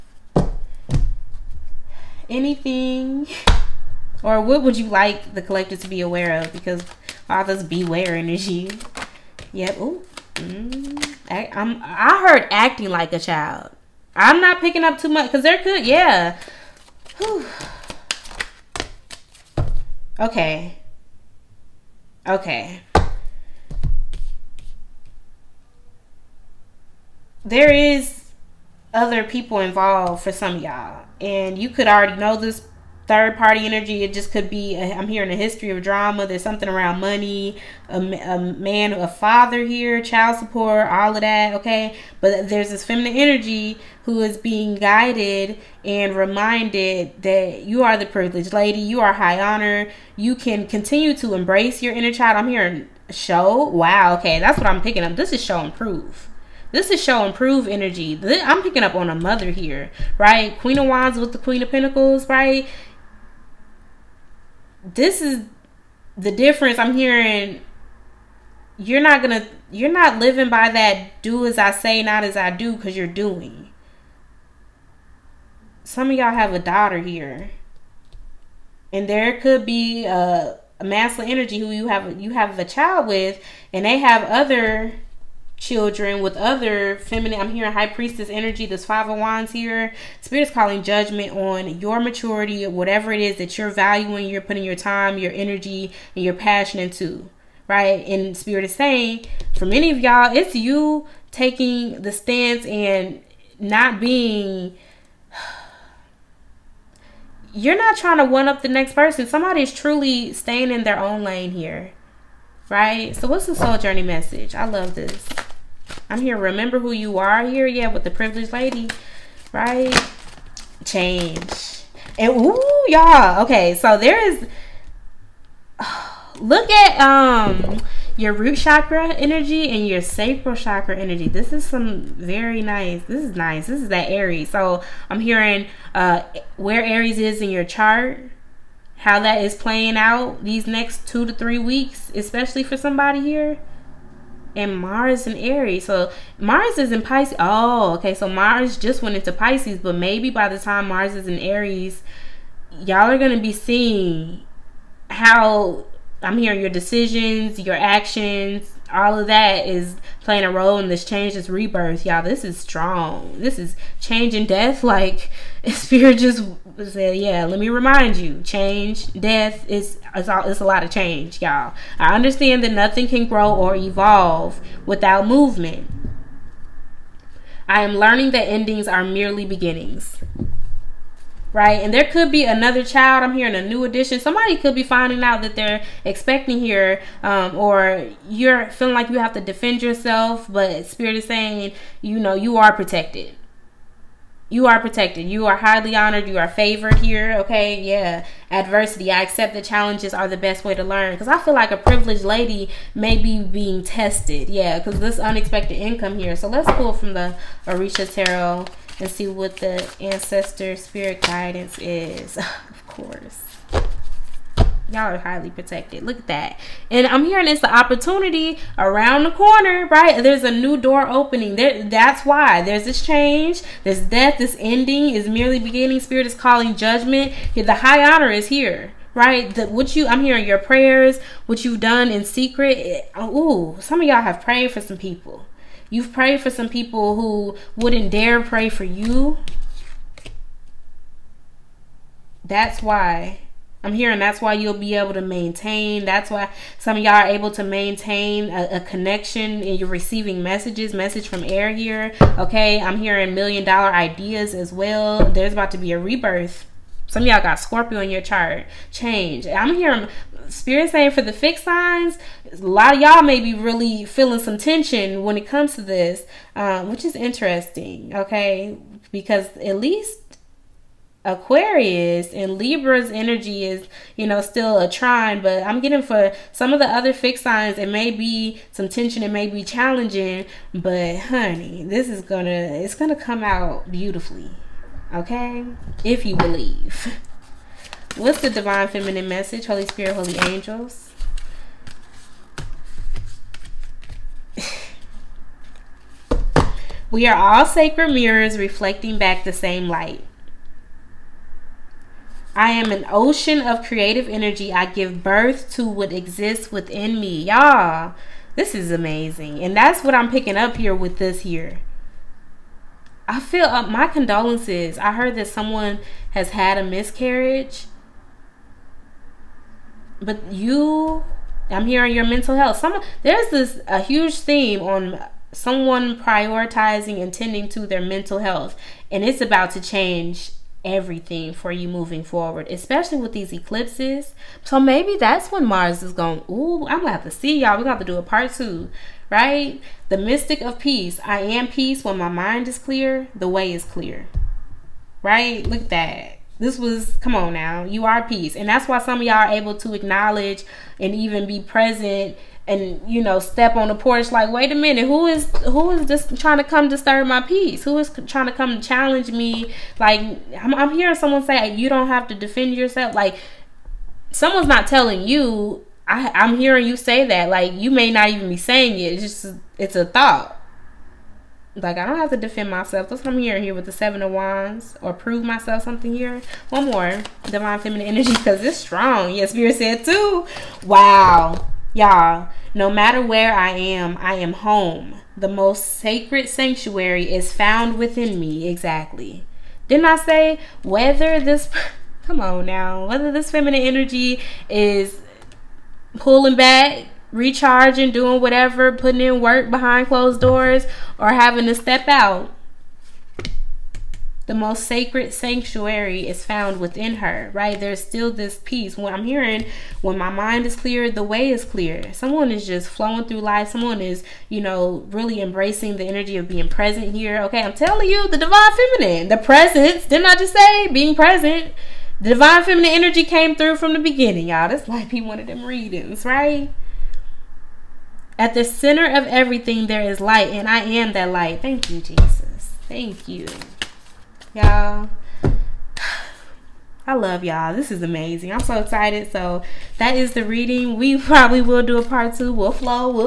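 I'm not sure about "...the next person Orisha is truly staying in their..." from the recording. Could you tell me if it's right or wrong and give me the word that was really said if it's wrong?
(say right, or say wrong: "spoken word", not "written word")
wrong: "Somebody", not "Orisha".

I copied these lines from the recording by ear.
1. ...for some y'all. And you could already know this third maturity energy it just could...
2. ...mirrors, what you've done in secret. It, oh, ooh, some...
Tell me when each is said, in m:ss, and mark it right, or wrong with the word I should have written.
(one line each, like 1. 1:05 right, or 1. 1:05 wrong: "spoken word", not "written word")
1. 0:30 wrong: "party", not "maturity"
2. 3:50 wrong: "prayers", not "mirrors".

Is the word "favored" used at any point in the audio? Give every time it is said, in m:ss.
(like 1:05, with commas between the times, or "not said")
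3:16.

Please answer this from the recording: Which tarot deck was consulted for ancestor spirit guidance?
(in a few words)
Orisha Tarot.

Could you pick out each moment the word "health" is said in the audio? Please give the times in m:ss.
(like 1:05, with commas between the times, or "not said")
5:22, 5:28.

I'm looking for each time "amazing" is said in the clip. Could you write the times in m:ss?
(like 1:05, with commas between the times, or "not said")
5:08, 7:18.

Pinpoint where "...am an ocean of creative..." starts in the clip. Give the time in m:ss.
5:02.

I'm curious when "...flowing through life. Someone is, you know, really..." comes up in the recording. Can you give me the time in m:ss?
6:52.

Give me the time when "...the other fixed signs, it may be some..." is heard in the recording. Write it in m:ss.
4:36.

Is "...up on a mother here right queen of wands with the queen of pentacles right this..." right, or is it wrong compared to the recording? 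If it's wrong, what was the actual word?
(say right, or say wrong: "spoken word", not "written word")
right.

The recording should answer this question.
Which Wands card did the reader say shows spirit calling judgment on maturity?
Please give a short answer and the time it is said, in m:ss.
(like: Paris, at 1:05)
Five of Wands, at 1:28.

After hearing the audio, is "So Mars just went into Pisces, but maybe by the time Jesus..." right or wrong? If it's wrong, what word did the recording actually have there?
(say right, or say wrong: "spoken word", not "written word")
wrong: "Mars", not "Jesus".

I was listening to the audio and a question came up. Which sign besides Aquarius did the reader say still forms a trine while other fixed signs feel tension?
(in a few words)
Libra.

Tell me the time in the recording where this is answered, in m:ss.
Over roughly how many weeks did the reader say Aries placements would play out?
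2:21.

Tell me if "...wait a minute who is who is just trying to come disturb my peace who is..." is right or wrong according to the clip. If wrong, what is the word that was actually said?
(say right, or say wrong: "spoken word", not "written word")
right.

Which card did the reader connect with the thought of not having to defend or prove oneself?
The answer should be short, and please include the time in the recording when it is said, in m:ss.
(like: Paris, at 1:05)
Seven of Wands, at 6:13.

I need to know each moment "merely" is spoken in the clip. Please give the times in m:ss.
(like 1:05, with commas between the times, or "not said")
2:59, 3:45.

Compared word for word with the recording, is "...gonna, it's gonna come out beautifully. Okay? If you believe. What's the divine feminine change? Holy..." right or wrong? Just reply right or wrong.
wrong.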